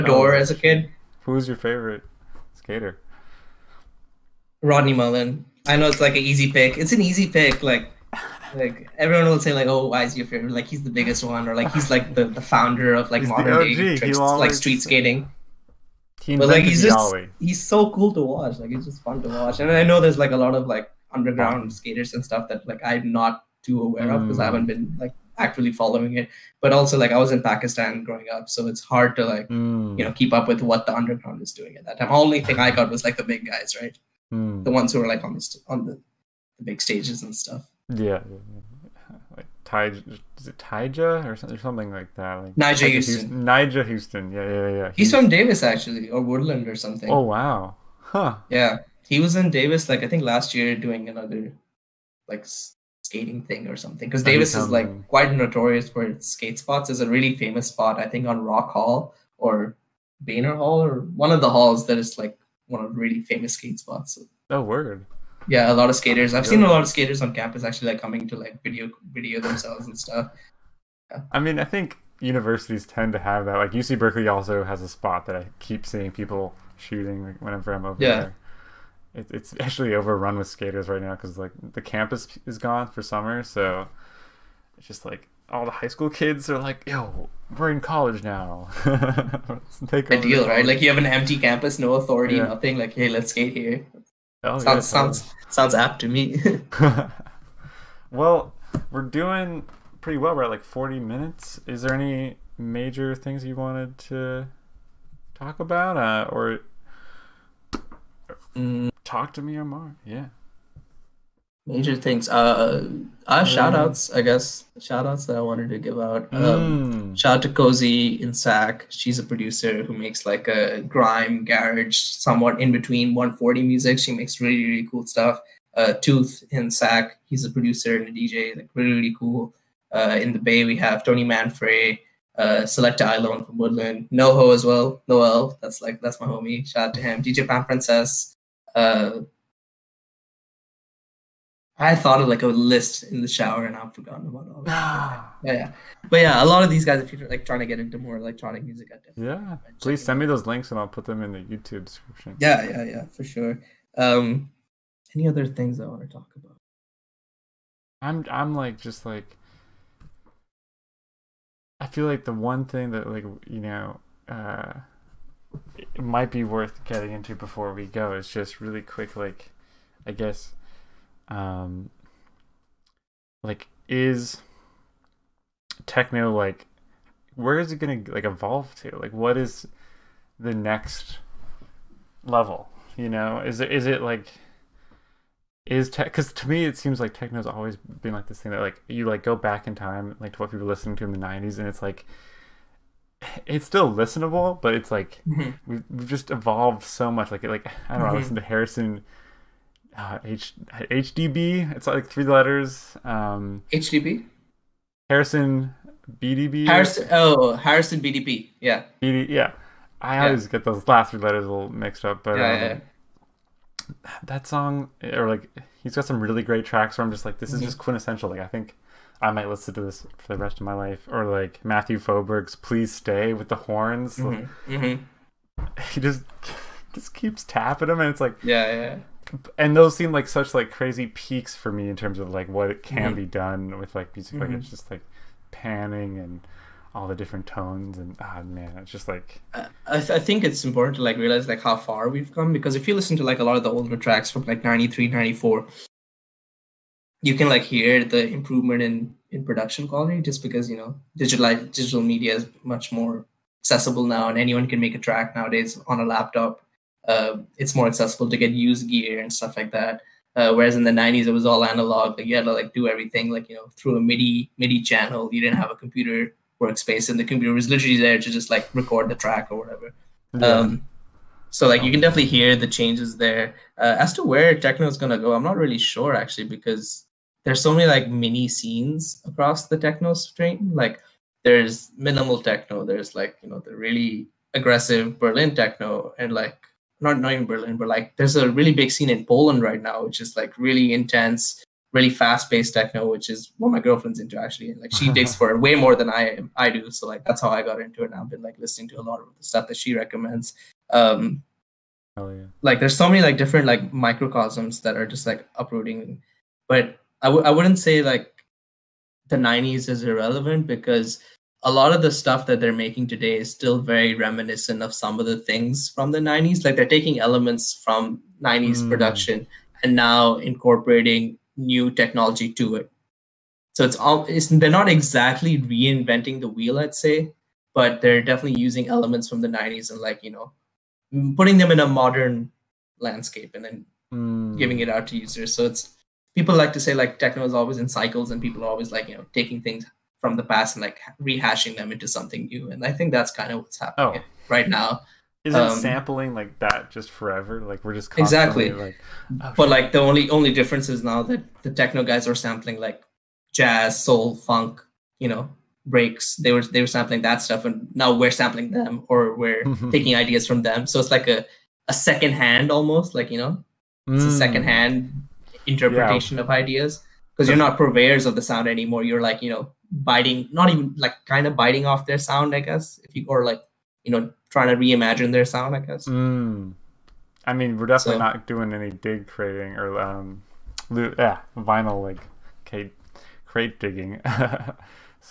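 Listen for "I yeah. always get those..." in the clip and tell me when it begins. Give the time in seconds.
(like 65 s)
209 s.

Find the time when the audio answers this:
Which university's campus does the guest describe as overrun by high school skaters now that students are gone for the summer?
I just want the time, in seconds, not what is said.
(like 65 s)
73 s.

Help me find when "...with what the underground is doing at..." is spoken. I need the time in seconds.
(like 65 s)
30 s.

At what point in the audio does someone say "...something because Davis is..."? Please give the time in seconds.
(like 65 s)
53 s.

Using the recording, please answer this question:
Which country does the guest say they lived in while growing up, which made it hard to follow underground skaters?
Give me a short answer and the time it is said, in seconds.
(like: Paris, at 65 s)
Pakistan, at 27 s.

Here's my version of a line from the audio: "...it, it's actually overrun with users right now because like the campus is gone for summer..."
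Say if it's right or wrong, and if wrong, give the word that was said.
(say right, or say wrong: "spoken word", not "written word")
wrong: "skaters", not "users".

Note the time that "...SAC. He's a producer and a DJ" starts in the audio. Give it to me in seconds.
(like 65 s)
126 s.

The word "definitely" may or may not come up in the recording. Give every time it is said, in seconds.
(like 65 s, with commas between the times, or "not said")
148 s, 271 s, 328 s, 377 s.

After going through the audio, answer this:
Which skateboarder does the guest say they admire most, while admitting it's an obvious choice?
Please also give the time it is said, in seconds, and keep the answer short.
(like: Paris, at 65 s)
Rodney Mullen, at 4 s.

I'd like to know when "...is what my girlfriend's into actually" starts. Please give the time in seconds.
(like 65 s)
293 s.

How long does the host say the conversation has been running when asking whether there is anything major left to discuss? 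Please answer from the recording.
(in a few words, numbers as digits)
40 minutes.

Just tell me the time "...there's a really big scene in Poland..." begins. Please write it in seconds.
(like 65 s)
288 s.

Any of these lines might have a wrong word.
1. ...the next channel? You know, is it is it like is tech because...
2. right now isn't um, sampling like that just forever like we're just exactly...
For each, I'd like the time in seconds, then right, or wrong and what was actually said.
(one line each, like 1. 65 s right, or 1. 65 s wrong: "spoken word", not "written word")
1. 180 s wrong: "level", not "channel"
2. 344 s right.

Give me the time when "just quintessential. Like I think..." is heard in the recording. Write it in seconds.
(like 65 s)
217 s.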